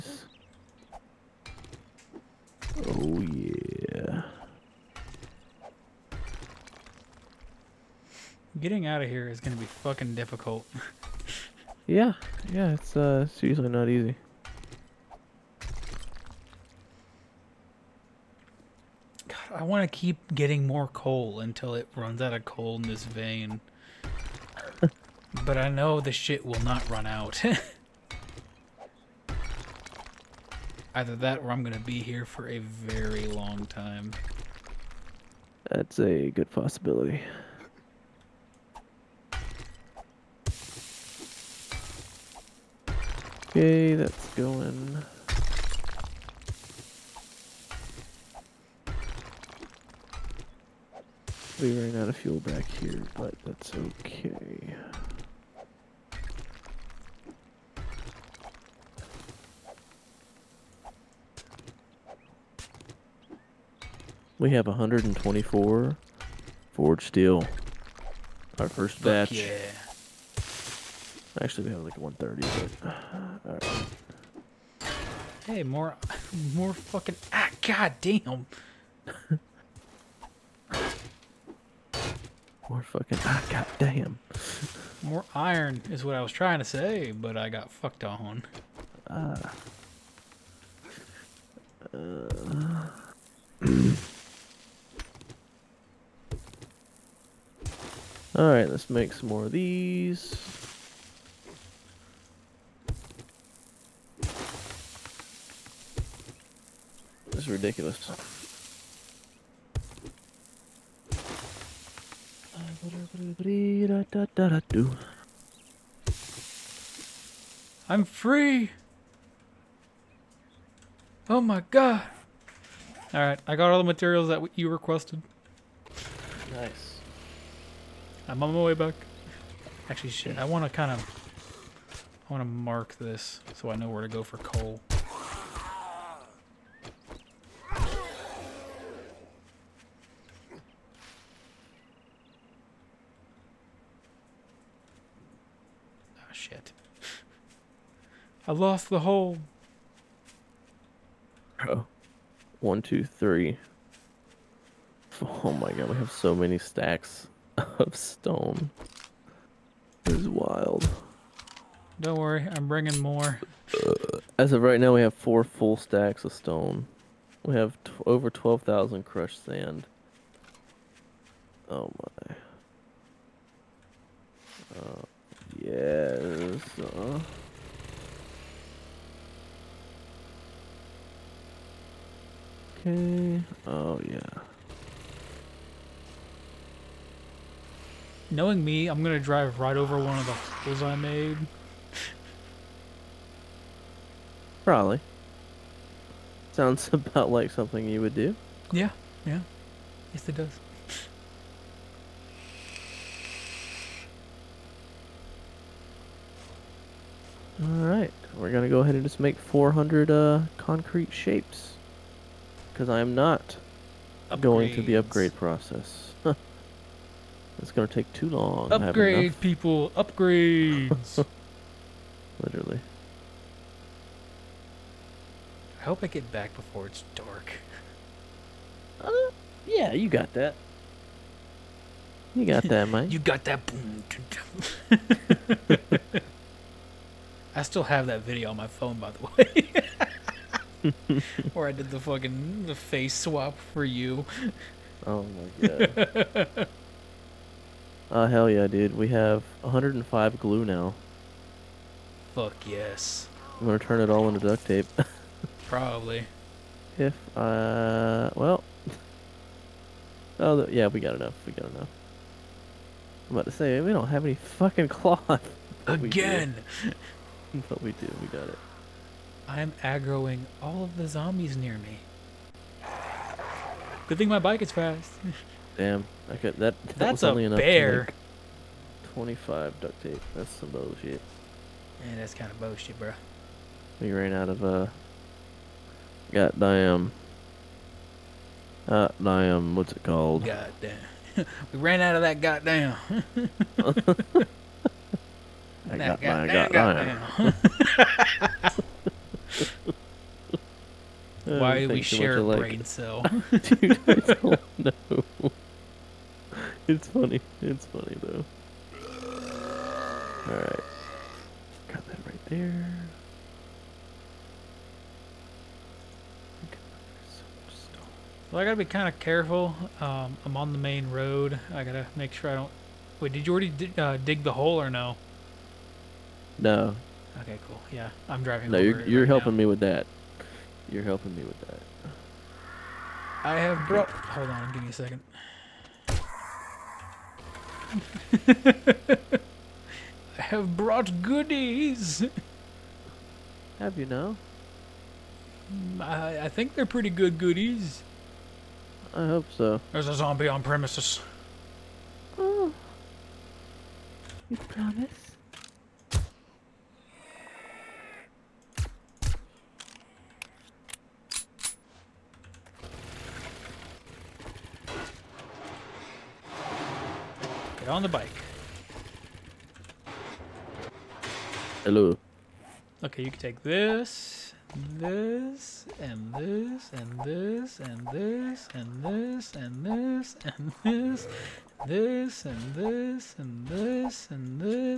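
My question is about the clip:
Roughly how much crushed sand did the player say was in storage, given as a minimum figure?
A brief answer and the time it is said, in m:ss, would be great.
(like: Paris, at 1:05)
over 12,000, at 2:48.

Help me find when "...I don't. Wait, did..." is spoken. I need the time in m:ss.
5:22.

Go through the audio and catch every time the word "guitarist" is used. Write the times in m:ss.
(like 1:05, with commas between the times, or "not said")
not said.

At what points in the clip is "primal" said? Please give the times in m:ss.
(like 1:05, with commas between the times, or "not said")
not said.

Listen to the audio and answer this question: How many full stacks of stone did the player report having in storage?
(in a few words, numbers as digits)
4.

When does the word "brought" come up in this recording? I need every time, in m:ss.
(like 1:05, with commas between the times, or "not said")
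5:33, 5:40.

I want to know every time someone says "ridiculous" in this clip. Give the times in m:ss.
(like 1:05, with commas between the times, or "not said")
1:47.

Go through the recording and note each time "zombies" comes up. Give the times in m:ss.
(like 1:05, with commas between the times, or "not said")
4:31, 5:50.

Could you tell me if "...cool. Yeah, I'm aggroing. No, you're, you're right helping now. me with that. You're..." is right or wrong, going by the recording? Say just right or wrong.
wrong.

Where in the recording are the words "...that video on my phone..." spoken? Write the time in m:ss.
3:58.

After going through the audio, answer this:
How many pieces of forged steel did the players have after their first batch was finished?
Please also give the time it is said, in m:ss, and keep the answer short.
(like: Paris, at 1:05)
124, at 1:04.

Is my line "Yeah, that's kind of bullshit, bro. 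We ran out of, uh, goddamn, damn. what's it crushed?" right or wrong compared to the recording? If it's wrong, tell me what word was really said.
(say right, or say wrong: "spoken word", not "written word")
wrong: "called", not "crushed".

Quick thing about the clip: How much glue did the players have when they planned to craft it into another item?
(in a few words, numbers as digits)
105.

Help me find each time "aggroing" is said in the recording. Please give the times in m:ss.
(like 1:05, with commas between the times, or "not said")
4:29.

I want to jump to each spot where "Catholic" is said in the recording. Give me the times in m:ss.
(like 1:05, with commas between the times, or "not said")
not said.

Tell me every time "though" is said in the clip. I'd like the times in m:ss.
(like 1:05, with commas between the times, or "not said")
5:08.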